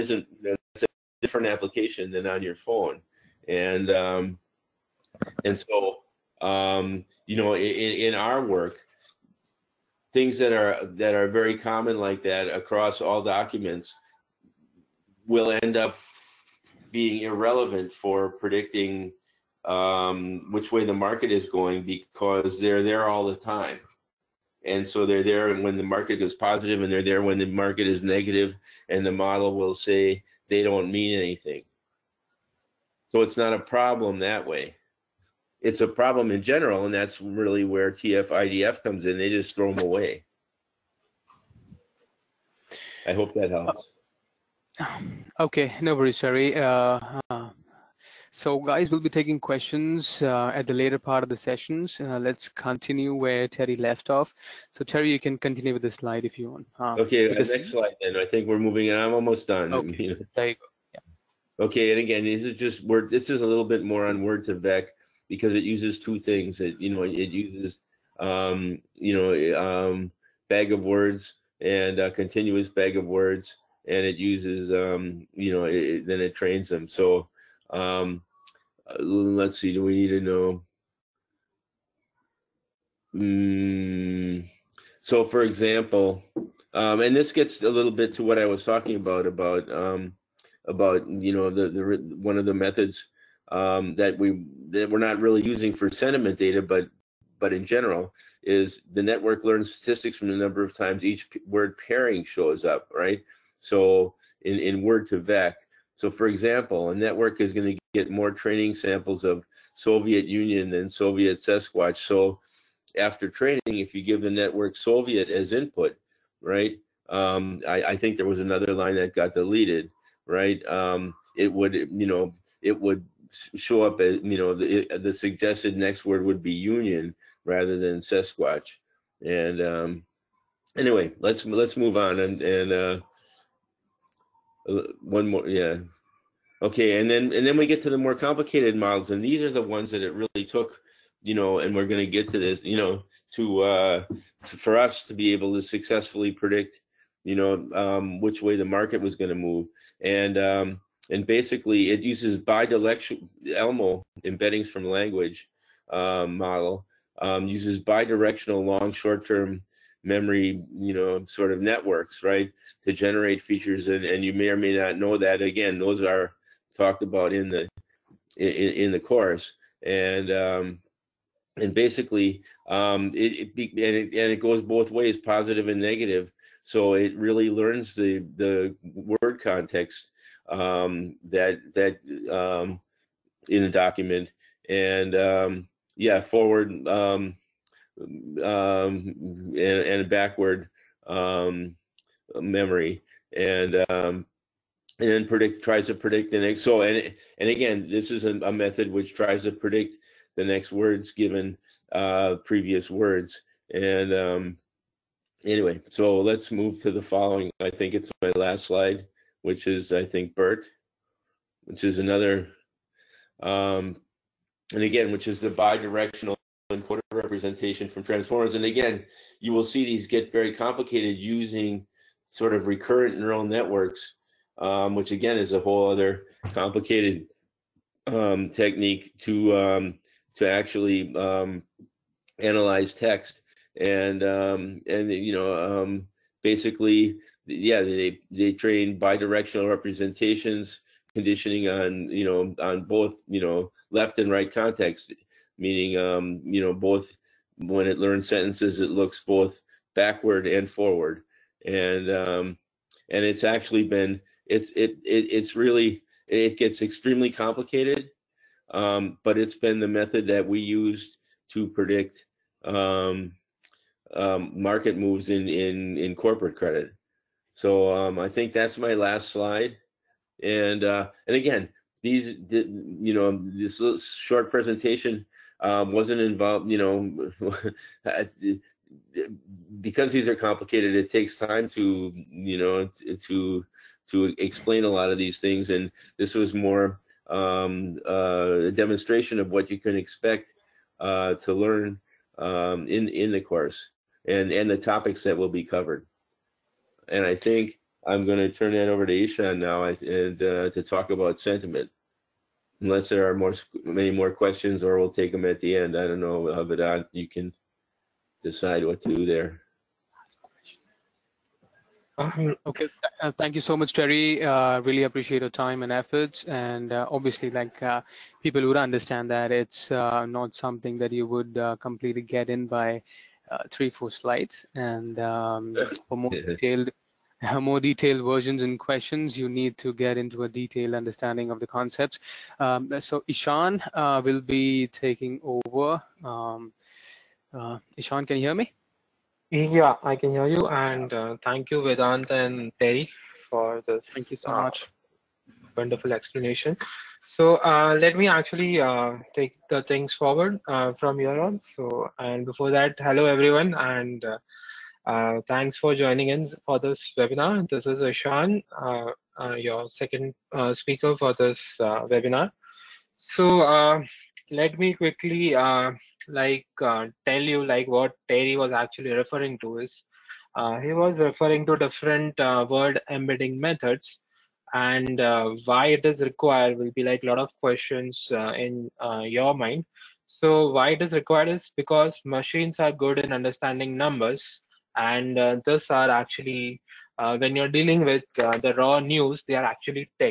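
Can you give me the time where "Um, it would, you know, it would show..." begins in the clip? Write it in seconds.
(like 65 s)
120 s.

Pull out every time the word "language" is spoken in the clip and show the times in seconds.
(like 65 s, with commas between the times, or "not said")
154 s.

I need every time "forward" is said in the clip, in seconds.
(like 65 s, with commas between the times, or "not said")
186 s, 250 s, 350 s.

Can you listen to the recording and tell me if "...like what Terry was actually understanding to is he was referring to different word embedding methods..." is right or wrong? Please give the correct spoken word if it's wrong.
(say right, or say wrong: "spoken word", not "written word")
wrong: "referring", not "understanding".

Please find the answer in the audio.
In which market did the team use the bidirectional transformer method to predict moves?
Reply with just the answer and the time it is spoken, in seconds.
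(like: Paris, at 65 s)
corporate credit, at 266 s.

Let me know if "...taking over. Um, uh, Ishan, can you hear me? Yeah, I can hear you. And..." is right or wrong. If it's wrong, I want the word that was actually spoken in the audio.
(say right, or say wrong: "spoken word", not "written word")
right.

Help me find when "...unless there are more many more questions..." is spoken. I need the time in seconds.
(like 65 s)
302 s.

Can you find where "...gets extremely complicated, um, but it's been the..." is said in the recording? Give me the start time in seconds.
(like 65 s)
256 s.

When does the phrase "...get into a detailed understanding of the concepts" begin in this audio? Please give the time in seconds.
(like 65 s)
329 s.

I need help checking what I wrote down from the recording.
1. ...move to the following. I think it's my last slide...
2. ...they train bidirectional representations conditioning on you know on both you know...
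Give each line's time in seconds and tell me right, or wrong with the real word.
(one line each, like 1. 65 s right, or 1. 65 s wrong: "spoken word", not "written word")
1. 206 s right
2. 238 s right.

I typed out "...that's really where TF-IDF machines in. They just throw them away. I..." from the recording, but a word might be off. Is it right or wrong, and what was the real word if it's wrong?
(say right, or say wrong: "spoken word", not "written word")
wrong: "comes", not "machines".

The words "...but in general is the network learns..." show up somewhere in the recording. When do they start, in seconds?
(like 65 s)
97 s.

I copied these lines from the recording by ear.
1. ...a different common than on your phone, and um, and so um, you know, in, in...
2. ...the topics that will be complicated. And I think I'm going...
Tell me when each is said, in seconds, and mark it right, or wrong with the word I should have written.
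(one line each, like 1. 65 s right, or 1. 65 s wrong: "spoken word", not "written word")
1. 0 s wrong: "application", not "common"
2. 294 s wrong: "covered", not "complicated".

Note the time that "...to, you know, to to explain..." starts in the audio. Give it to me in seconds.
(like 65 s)
281 s.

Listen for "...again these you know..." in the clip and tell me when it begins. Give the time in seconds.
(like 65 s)
271 s.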